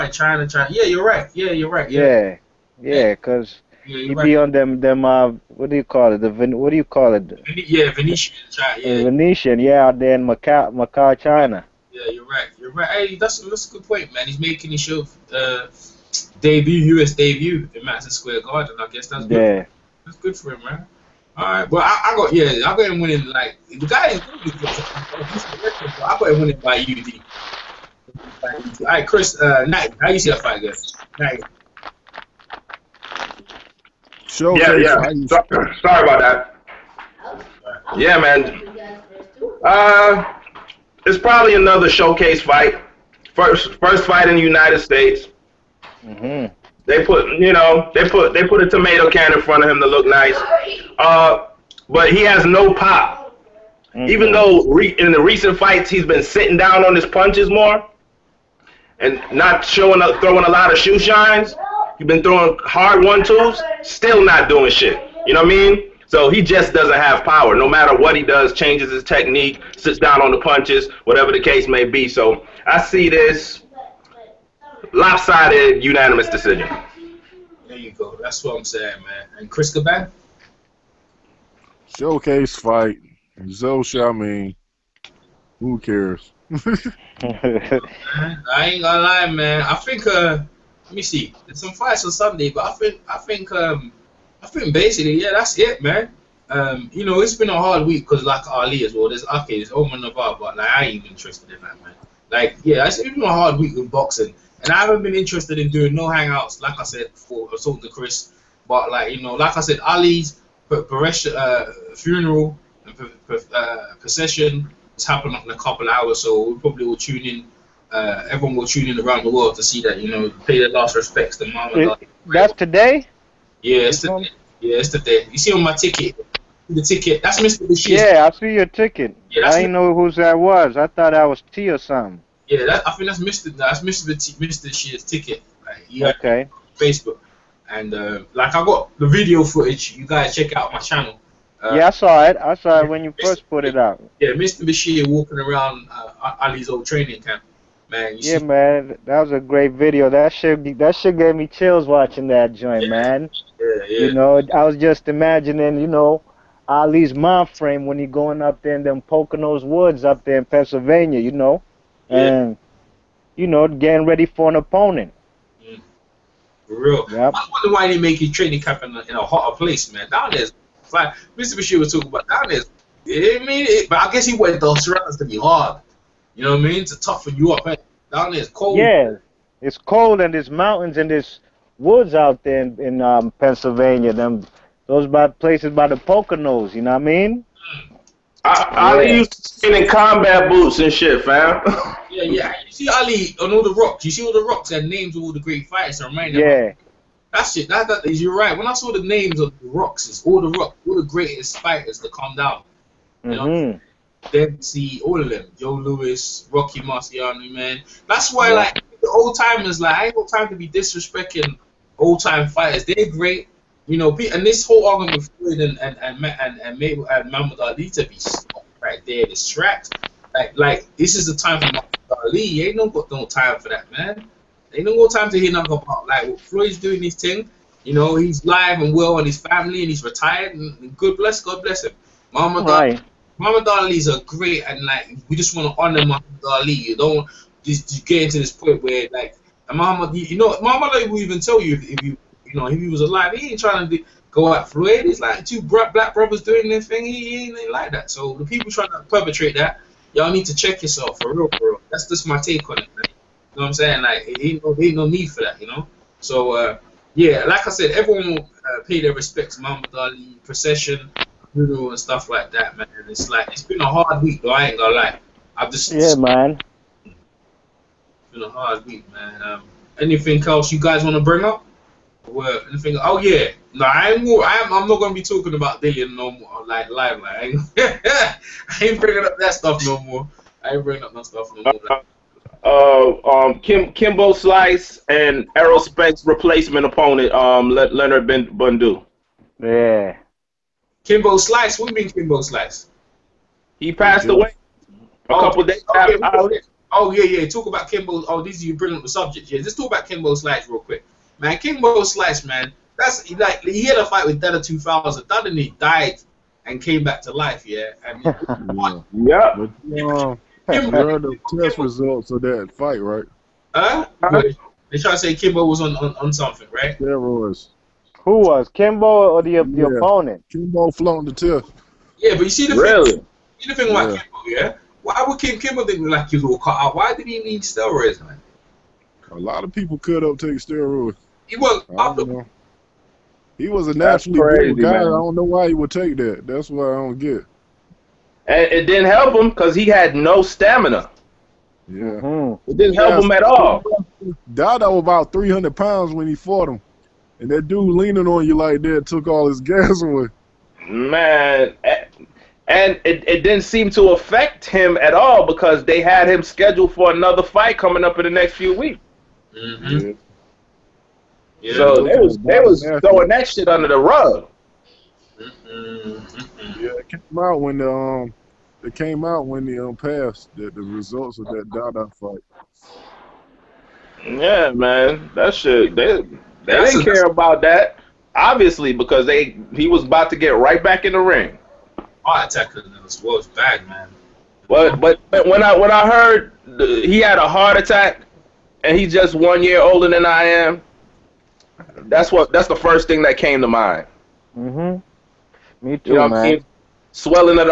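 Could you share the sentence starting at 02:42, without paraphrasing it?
and you know, getting ready for an opponent.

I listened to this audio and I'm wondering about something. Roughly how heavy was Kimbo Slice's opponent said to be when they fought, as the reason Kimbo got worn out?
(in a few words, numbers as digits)
300 pounds.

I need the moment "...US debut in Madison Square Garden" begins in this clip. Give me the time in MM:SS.
00:17.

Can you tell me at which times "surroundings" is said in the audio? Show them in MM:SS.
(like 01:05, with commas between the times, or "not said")
02:54.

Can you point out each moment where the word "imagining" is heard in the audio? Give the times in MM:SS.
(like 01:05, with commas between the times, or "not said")
02:35.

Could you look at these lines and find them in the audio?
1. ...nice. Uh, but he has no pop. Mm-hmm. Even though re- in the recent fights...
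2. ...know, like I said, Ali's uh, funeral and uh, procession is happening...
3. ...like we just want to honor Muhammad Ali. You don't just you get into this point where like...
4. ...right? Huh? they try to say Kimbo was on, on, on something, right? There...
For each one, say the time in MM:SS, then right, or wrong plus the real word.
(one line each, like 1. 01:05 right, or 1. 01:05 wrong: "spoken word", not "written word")
1. 00:50 right
2. 01:49 right
3. 03:54 right
4. 05:13 right.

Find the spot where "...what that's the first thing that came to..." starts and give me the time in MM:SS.
06:32.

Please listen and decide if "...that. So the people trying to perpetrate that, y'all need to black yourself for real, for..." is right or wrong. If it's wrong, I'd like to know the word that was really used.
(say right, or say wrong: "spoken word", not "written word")
wrong: "check", not "black".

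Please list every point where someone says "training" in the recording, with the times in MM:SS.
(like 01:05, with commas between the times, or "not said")
02:26, 02:48.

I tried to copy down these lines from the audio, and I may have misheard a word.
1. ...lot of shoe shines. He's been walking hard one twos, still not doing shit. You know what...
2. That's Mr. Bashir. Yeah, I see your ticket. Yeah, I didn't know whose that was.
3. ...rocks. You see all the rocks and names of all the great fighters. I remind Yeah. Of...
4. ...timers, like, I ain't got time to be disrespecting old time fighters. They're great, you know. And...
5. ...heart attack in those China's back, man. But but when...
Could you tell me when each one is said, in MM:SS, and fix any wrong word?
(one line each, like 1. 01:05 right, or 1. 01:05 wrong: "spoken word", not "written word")
1. 01:00 wrong: "throwing", not "walking"
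2. 02:07 right
3. 03:13 right
4. 03:29 right
5. 06:22 wrong: "Wolf", not "China".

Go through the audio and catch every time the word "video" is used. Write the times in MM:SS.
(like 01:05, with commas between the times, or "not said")
02:19, 02:29.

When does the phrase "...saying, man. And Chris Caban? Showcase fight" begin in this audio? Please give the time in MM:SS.
01:18.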